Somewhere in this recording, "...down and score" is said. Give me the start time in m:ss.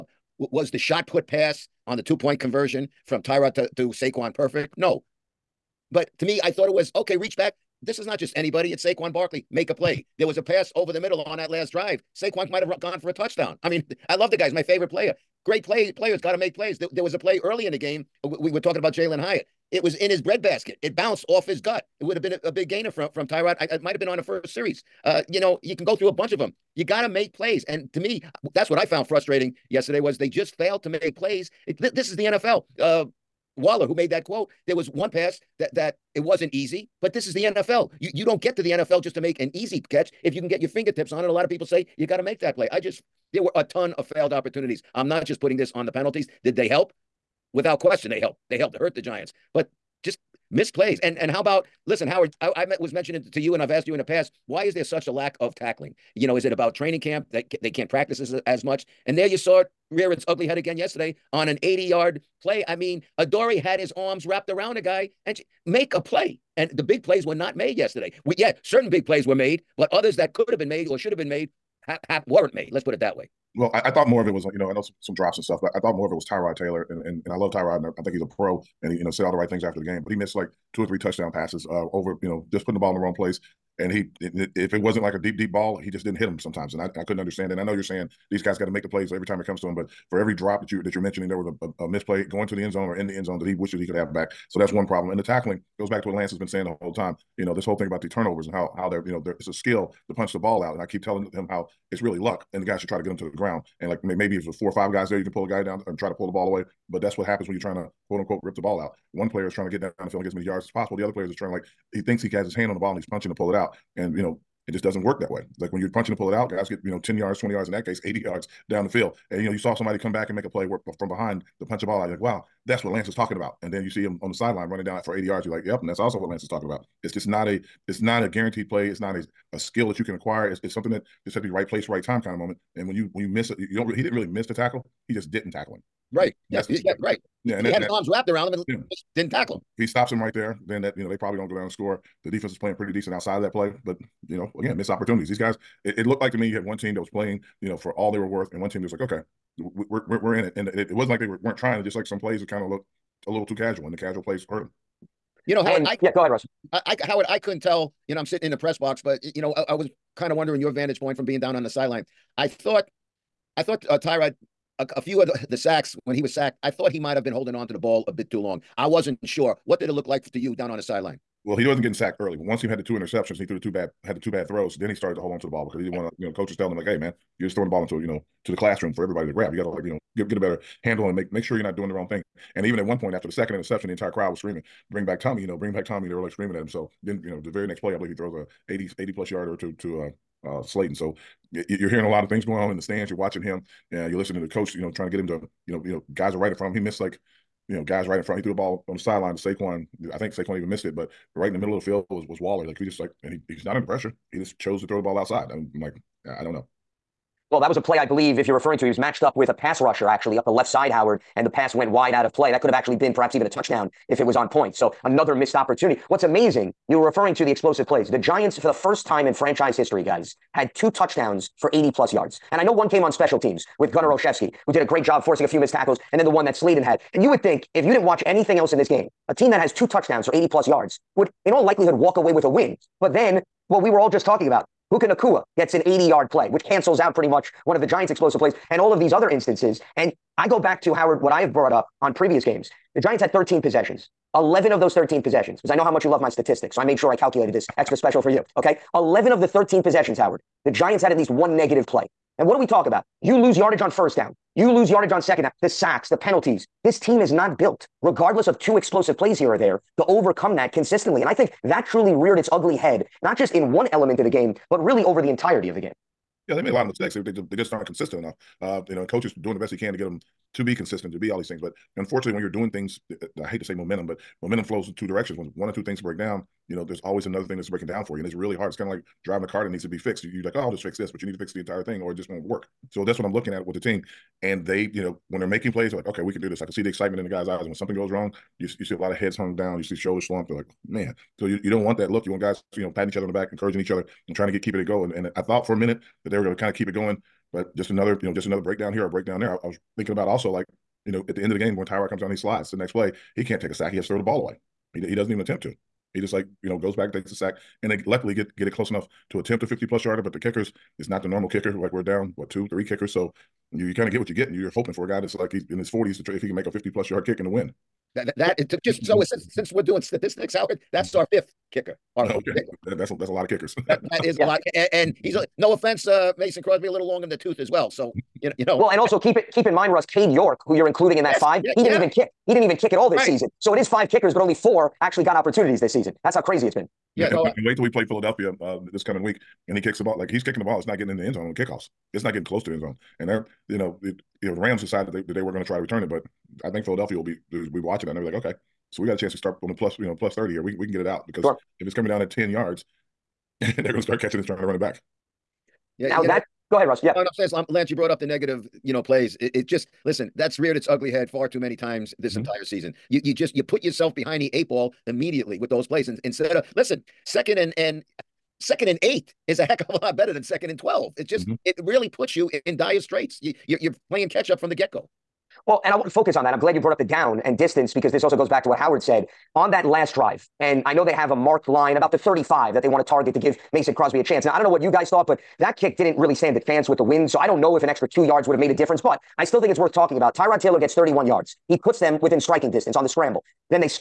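2:21.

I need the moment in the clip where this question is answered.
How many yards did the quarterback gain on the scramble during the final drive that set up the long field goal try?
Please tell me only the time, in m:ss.
6:30.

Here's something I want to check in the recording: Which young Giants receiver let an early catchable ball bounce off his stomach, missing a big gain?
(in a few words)
Jalin Hyatt.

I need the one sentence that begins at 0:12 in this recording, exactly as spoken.
Saquon might have gone for a touchdown.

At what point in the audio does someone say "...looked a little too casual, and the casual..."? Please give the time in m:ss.
2:32.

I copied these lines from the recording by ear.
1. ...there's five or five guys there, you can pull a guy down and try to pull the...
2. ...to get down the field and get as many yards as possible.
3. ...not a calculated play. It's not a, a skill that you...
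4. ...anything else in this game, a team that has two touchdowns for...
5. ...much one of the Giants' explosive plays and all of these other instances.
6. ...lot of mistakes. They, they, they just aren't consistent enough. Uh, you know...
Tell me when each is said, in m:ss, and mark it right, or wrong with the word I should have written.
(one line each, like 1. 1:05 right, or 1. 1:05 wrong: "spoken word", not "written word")
1. 1:44 wrong: "four", not "five"
2. 1:49 right
3. 2:08 wrong: "guaranteed", not "calculated"
4. 3:48 right
5. 3:57 right
6. 4:26 right.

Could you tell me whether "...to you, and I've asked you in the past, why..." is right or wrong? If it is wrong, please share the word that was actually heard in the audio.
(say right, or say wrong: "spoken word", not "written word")
right.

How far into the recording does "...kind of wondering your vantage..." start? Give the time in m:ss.
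2:40.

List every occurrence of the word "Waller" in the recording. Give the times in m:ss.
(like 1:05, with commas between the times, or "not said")
0:33, 3:22.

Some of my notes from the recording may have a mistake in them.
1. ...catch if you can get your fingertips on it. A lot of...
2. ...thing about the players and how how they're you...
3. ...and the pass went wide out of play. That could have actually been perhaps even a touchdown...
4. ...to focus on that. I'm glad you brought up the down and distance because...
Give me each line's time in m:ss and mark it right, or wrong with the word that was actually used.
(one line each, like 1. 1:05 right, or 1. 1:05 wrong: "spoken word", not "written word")
1. 0:39 right
2. 1:37 wrong: "turnovers", not "players"
3. 3:31 right
4. 6:16 right.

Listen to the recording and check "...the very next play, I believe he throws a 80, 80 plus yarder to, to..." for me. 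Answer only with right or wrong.
right.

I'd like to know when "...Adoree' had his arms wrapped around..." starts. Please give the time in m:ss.
1:03.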